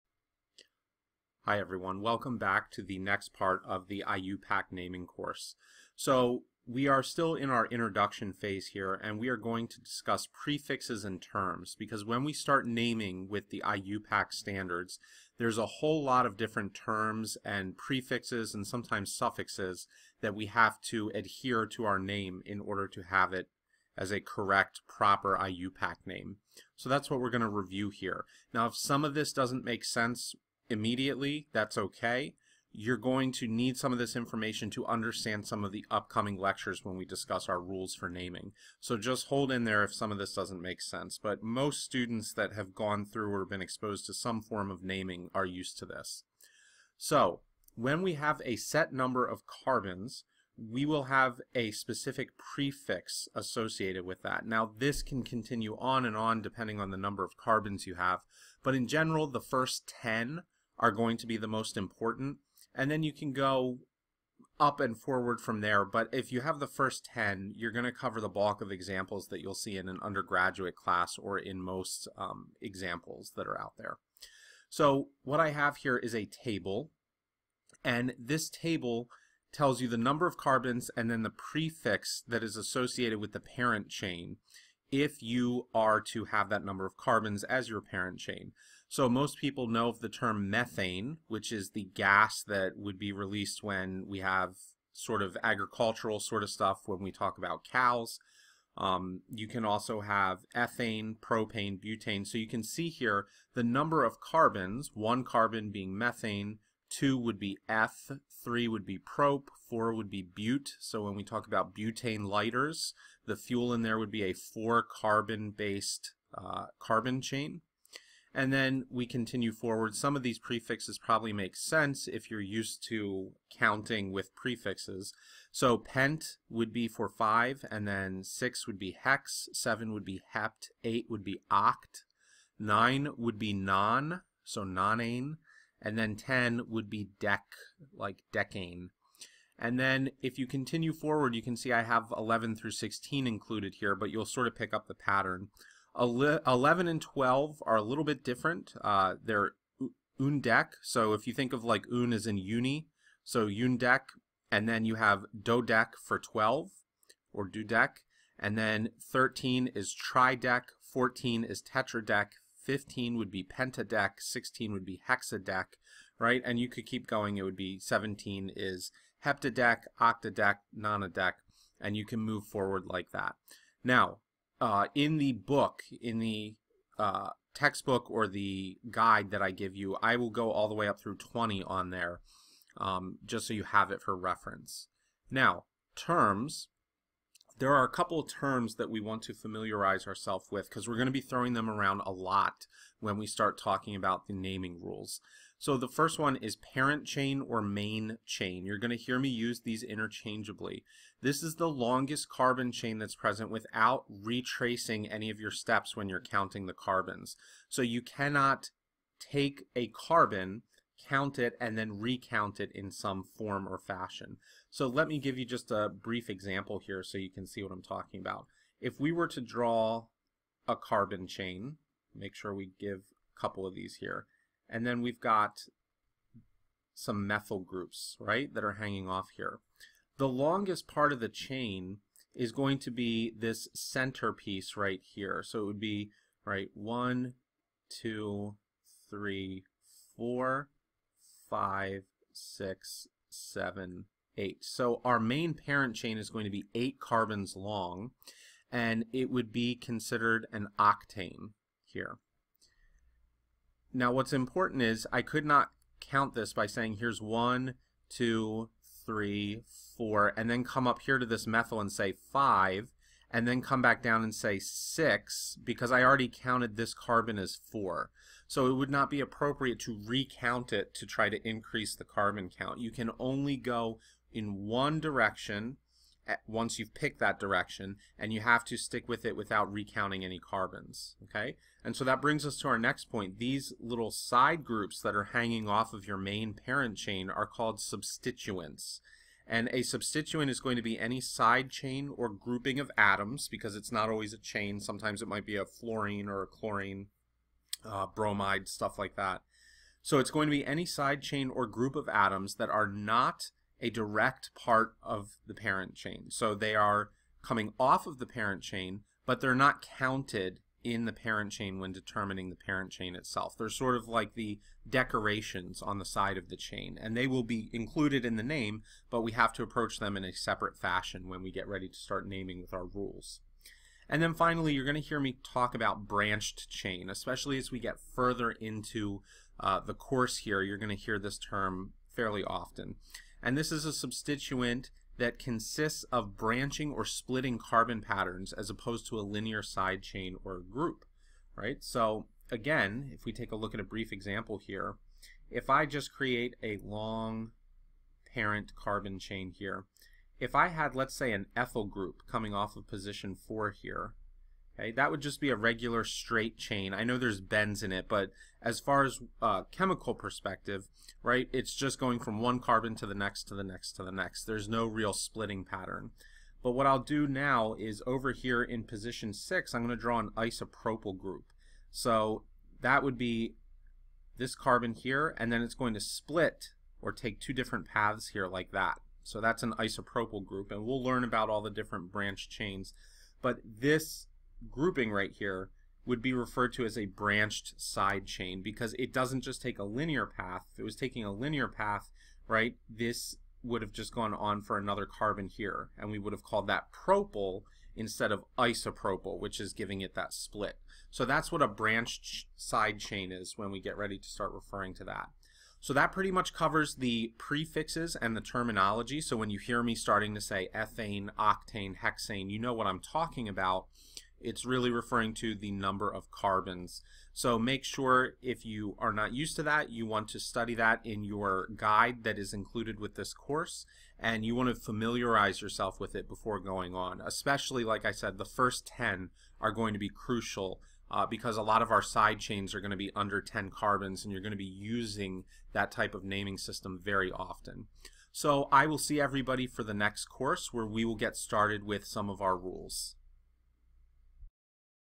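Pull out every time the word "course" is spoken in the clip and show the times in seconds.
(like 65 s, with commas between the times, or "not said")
5 s, 329 s, 423 s, 440 s.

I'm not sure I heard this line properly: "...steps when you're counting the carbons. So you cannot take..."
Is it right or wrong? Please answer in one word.
right.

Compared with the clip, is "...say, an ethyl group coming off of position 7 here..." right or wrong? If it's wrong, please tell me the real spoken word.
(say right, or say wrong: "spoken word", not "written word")
wrong: "4", not "7".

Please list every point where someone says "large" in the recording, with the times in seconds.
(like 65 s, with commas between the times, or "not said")
not said.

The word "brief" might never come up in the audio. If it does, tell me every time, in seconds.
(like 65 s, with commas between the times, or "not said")
215 s, 343 s.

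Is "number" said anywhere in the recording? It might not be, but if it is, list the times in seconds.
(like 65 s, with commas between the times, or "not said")
48 s, 56 s, 79 s, 86 s, 103 s, 415 s.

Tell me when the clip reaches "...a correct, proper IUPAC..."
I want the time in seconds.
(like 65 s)
24 s.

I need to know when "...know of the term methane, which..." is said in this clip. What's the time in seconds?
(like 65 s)
89 s.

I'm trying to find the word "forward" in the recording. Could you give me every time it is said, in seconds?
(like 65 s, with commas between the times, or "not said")
64 s, 119 s, 140 s, 172 s.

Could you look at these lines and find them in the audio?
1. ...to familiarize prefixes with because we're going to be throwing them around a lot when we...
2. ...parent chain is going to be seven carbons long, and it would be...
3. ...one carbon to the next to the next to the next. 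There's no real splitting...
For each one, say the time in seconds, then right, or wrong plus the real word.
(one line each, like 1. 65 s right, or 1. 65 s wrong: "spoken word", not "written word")
1. 189 s wrong: "ourselves", not "prefixes"
2. 245 s wrong: "eight", not "seven"
3. 362 s right.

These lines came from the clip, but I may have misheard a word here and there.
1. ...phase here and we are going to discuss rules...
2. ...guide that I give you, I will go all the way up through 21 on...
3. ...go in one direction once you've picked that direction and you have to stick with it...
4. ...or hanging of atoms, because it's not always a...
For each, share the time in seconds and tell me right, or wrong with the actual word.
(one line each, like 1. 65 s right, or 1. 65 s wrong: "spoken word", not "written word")
1. 8 s wrong: "prefixes", not "rules"
2. 178 s wrong: "20", not "21"
3. 273 s right
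4. 292 s wrong: "grouping", not "hanging".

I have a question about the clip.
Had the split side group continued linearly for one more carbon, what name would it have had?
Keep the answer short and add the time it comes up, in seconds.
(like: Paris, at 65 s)
propyl, at 396 s.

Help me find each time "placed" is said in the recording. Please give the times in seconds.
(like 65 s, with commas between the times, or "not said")
not said.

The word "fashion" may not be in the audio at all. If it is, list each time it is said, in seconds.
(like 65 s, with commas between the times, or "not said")
213 s, 320 s.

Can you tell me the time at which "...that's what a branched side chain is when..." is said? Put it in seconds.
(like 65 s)
401 s.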